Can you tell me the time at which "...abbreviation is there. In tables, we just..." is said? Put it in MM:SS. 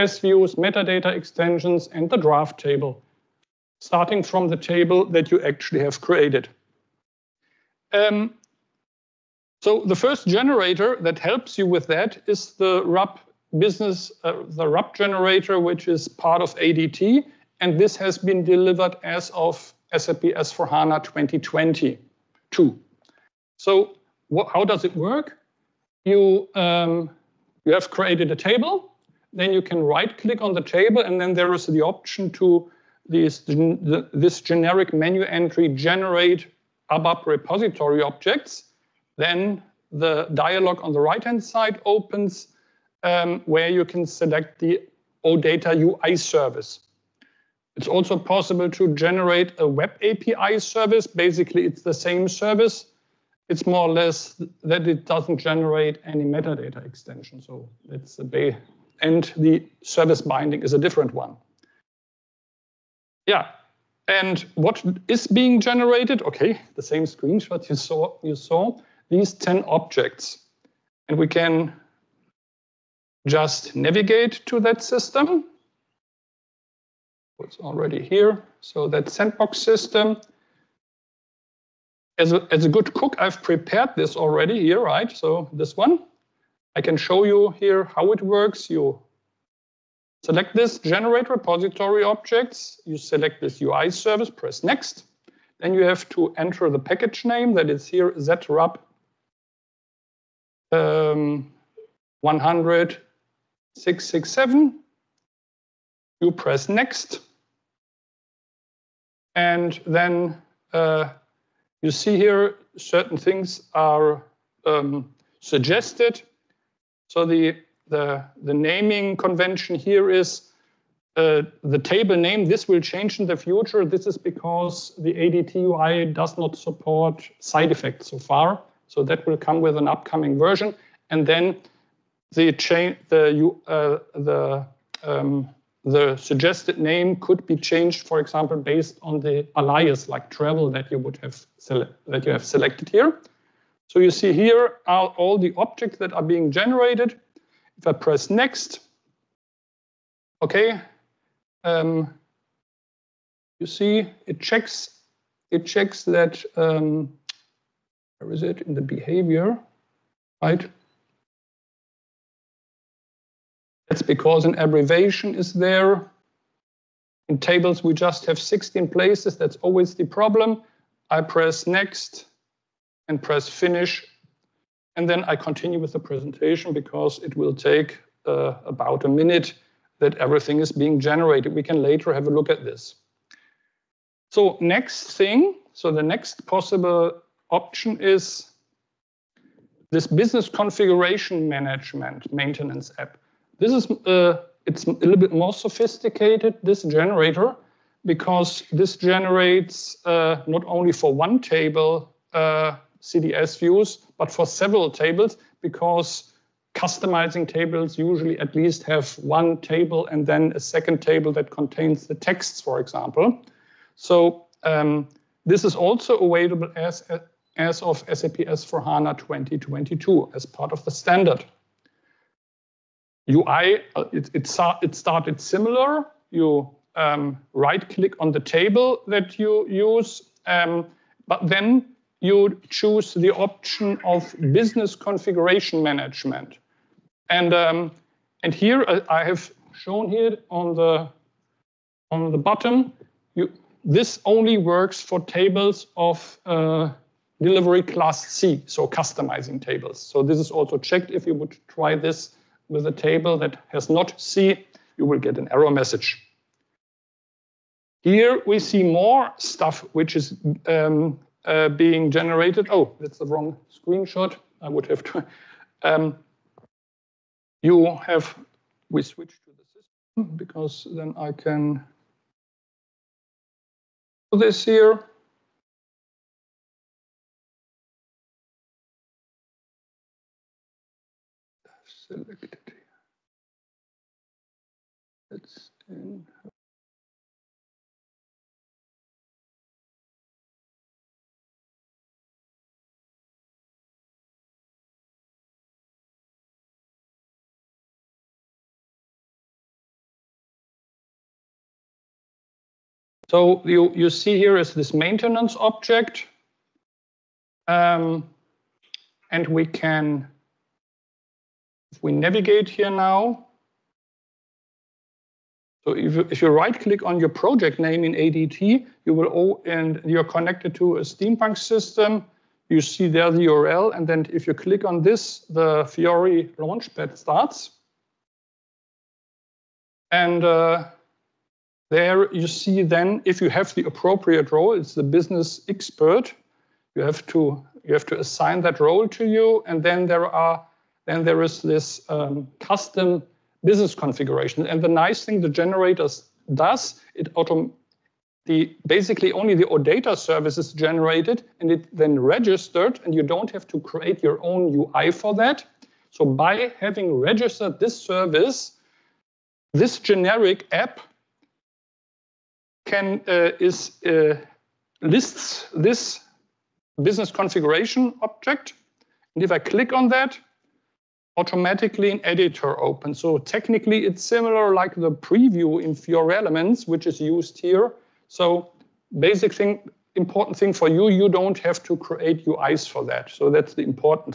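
02:44.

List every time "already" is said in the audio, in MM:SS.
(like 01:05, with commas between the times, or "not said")
01:17, 01:24.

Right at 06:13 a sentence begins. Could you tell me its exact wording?
So technically it's similar like the preview in Fiori Elements, which is used here.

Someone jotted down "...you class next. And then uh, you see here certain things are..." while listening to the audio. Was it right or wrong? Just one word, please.
wrong.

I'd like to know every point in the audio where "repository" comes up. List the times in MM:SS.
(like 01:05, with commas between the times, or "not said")
00:37, 01:31.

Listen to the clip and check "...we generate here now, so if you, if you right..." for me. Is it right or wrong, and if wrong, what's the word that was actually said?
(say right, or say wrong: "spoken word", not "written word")
wrong: "navigate", not "generate".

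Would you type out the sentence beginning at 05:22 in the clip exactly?
You see there the URL, and then if you click on this, the Fiori Launchpad starts.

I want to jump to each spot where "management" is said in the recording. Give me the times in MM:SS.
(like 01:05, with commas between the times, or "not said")
03:11, 03:55.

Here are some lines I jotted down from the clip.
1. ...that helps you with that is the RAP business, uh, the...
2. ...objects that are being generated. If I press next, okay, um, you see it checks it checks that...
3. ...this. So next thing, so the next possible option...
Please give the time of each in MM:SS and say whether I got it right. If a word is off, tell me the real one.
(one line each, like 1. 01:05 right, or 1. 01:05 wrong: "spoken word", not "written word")
1. 00:10 right
2. 02:25 right
3. 03:02 right.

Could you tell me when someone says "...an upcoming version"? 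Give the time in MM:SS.
02:09.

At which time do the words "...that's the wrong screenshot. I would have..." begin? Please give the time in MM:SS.
04:22.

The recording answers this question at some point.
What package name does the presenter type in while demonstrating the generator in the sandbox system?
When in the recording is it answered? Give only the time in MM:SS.
01:38.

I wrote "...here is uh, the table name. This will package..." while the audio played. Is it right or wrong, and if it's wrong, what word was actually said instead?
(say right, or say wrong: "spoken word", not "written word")
wrong: "change", not "package".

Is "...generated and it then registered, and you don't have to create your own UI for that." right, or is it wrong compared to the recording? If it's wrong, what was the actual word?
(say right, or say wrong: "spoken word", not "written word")
right.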